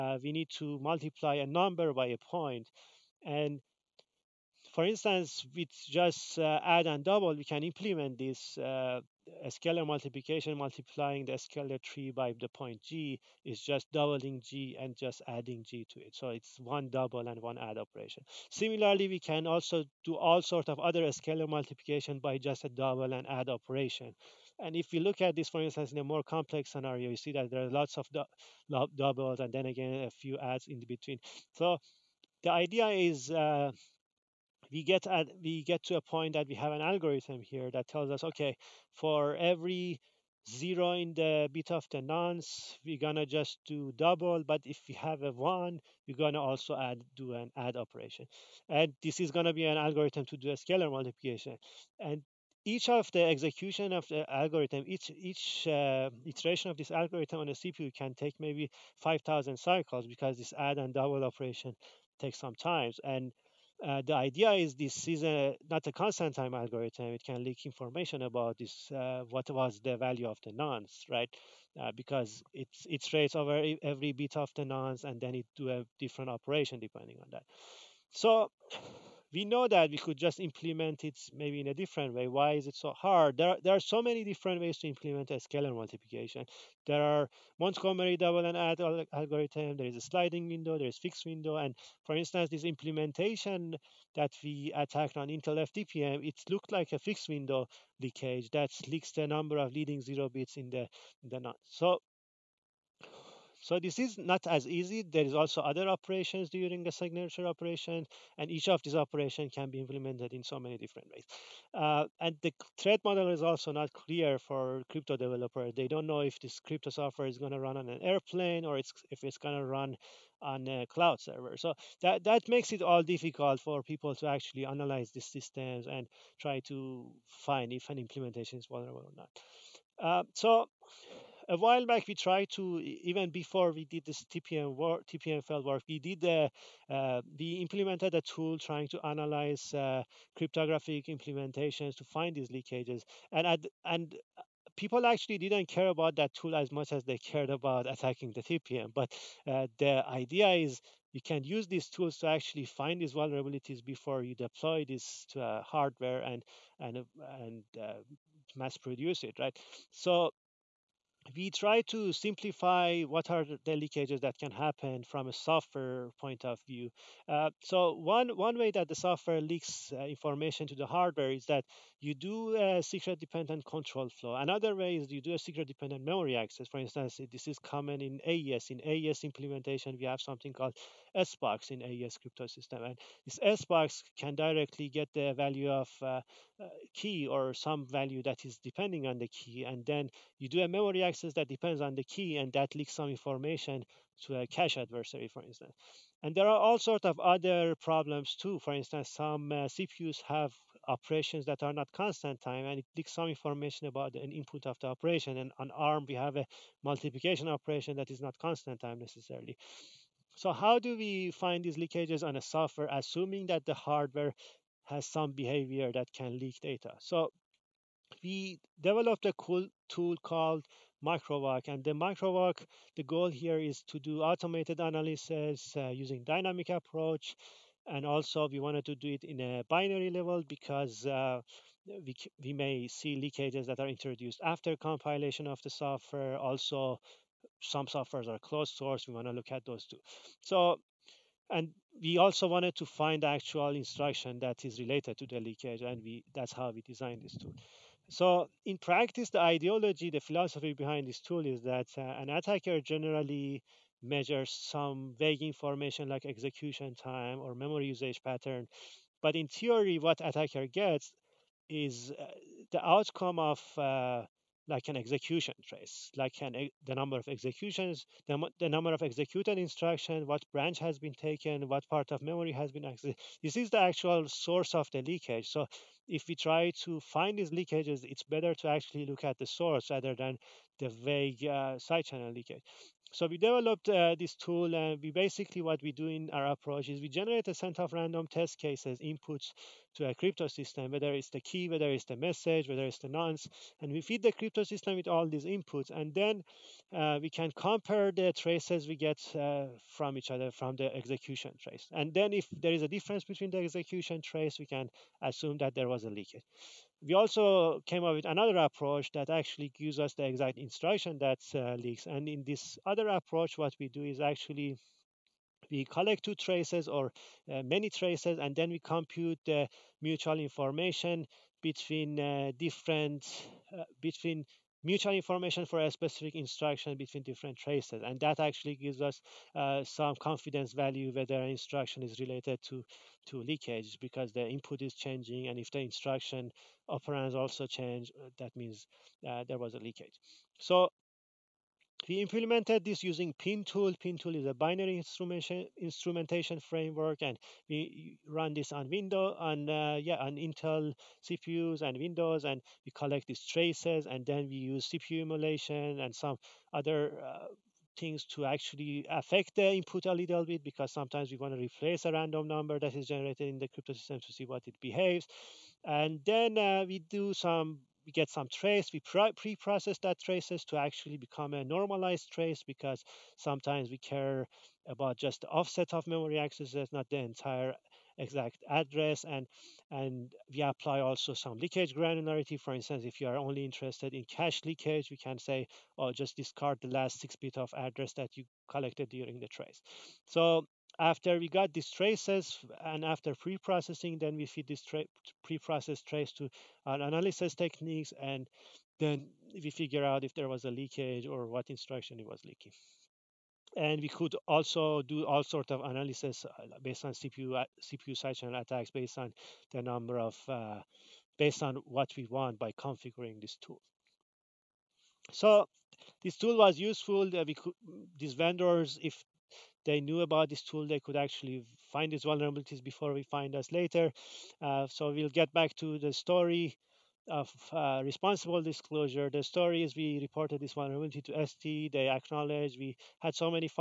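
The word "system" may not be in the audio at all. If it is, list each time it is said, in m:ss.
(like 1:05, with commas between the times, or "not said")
2:05, 3:02, 4:50, 4:54, 6:03.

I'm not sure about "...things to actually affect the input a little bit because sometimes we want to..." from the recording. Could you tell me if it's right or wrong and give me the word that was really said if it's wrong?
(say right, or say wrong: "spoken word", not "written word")
right.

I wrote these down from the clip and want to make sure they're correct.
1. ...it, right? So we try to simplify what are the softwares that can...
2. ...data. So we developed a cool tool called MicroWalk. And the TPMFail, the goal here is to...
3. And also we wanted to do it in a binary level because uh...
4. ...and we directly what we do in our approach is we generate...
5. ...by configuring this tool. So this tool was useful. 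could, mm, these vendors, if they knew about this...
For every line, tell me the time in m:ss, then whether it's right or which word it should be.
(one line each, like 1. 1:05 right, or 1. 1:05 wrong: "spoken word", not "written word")
1. 2:39 wrong: "leakages", not "softwares"
2. 3:36 wrong: "MicroWalk", not "TPMFail"
3. 3:47 right
4. 4:44 wrong: "basically", not "directly"
5. 6:52 right.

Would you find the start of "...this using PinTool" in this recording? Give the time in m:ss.
5:42.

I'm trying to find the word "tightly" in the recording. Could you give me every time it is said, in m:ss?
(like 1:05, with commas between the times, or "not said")
not said.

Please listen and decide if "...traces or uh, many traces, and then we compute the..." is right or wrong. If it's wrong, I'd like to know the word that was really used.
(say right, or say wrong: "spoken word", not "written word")
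right.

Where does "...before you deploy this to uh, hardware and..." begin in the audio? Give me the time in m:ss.
2:33.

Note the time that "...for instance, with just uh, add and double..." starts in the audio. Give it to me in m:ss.
0:04.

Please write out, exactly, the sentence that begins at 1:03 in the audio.
And uh, the idea is this is a, not a constant time algorithm.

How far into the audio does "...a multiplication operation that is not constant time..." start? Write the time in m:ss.
3:26.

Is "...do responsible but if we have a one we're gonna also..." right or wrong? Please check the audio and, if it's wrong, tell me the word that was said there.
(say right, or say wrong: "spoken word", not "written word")
wrong: "double", not "responsible".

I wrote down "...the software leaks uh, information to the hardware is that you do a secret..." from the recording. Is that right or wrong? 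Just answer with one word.
right.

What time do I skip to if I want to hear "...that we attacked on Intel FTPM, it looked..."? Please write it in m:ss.
1:34.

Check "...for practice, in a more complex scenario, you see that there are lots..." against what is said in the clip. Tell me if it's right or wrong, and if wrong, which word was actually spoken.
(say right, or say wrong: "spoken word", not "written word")
wrong: "instance", not "practice".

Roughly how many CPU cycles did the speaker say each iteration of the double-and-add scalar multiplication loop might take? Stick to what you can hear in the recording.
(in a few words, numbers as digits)
5,000.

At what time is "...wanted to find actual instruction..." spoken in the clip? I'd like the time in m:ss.
4:02.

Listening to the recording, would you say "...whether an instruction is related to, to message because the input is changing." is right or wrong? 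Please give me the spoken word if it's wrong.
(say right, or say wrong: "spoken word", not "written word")
wrong: "leakage", not "message".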